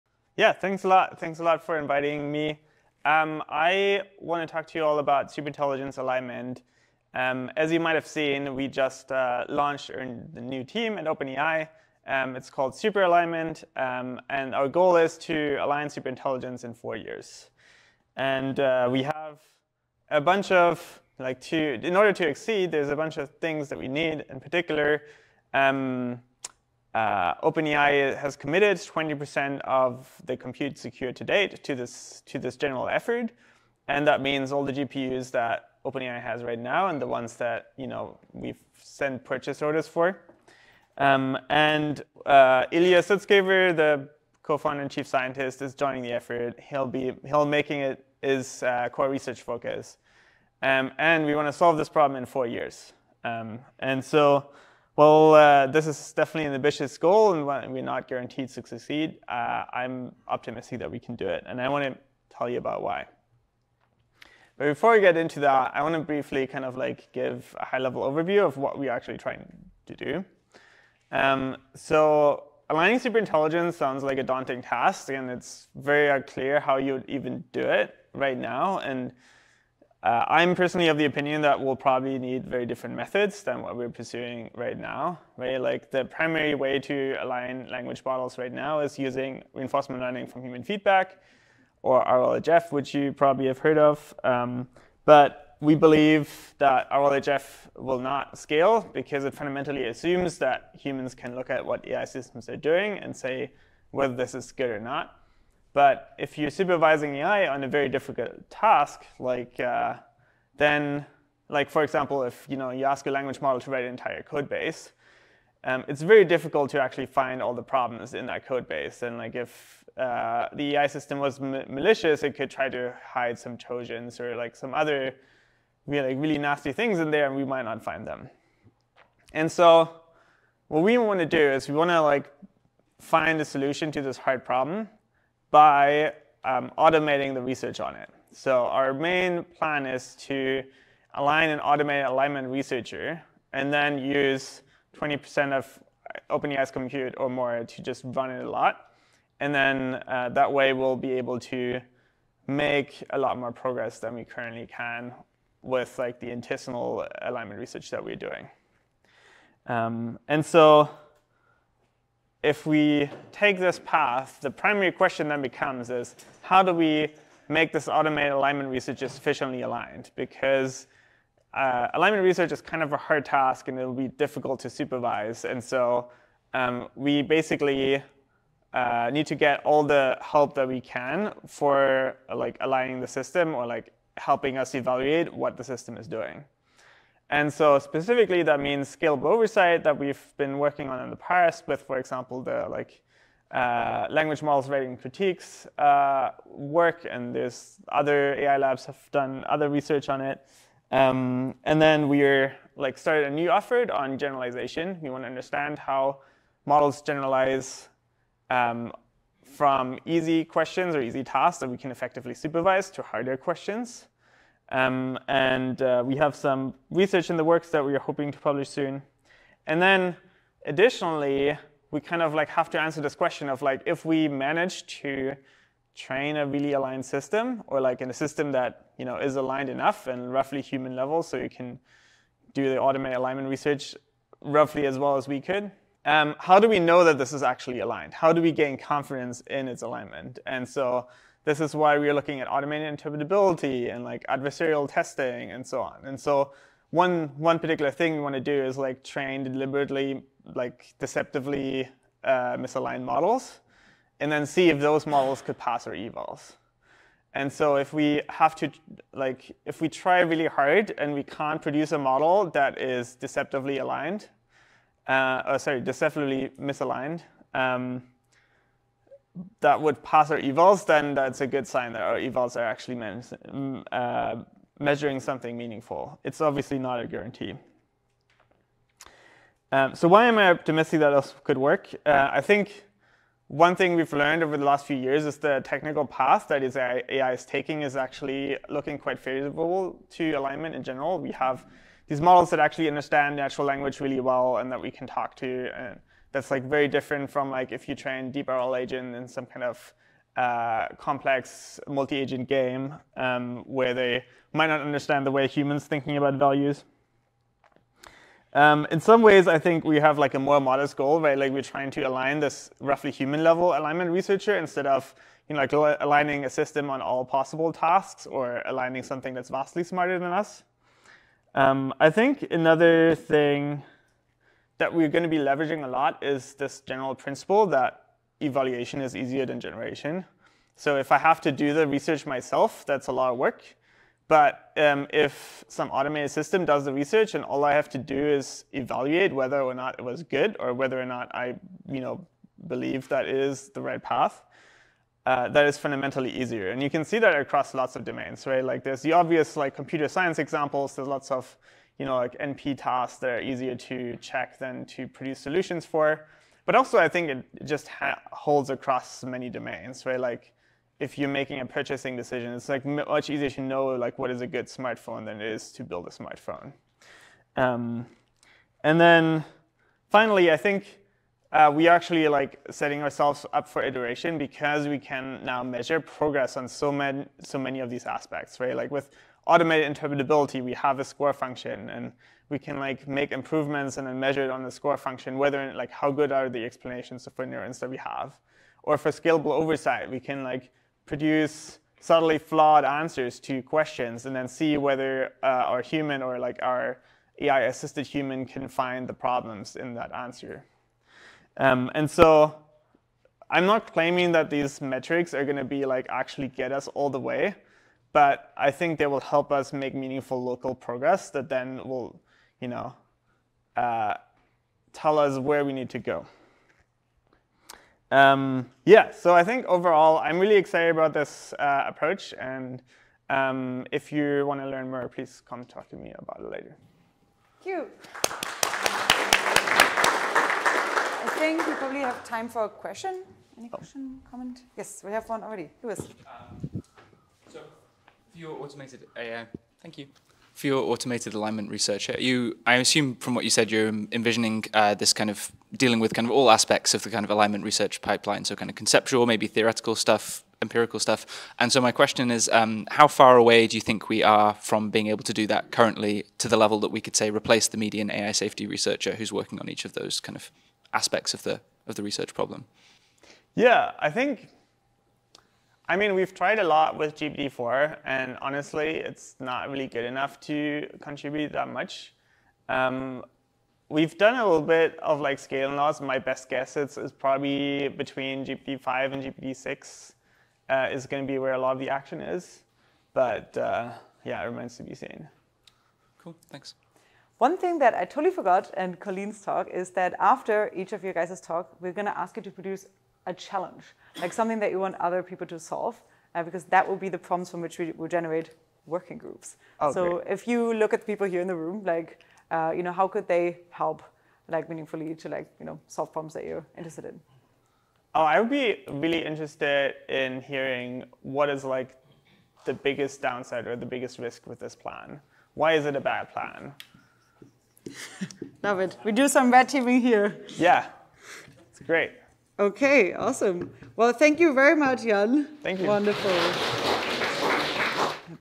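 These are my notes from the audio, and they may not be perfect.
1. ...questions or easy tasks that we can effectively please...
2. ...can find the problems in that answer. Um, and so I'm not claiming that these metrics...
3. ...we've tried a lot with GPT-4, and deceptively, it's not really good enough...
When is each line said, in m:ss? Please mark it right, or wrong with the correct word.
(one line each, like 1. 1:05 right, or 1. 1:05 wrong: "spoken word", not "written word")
1. 3:30 wrong: "supervise", not "please"
2. 6:38 right
3. 7:46 wrong: "honestly", not "deceptively".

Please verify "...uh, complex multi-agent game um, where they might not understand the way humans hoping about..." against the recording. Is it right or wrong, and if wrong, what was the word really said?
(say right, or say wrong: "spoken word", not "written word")
wrong: "thinking", not "hoping".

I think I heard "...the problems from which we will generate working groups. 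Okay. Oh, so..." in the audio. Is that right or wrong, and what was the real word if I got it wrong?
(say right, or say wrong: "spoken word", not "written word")
right.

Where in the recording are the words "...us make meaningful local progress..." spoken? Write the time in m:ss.
6:49.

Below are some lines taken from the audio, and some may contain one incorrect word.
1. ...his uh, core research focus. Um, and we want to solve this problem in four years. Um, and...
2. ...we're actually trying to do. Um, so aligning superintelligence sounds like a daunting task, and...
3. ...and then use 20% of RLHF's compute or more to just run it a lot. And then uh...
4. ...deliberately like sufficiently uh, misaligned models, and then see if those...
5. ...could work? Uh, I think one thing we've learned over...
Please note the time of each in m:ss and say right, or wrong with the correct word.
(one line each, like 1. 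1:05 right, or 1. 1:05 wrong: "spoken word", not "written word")
1. 0:48 right
2. 1:08 right
3. 2:23 wrong: "OpenAI", not "RLHF"
4. 4:09 wrong: "deceptively", not "sufficiently"
5. 4:41 right.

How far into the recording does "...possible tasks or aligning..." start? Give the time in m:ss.
5:17.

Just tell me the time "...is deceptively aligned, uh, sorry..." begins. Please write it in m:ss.
4:22.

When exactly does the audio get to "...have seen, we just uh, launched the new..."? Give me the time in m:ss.
0:07.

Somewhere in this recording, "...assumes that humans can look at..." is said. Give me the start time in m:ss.
1:39.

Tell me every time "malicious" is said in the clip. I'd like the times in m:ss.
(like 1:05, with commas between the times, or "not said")
2:01.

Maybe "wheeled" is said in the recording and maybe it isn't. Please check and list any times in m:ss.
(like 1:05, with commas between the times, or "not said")
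not said.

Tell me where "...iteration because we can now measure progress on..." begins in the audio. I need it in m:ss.
6:13.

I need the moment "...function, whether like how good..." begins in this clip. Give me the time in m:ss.
6:24.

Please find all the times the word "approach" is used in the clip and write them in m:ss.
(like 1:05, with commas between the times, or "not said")
7:01.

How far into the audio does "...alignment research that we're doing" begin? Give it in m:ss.
2:37.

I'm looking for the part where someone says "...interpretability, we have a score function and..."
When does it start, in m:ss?
6:19.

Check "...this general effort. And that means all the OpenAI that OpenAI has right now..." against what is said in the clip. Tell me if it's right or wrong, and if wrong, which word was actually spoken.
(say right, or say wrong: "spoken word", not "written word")
wrong: "GPUs", not "OpenAI".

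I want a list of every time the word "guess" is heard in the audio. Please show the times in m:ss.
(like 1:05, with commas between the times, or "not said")
7:56.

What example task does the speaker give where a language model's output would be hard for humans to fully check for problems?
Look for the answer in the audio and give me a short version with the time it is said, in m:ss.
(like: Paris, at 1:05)
write an entire code base, at 1:53.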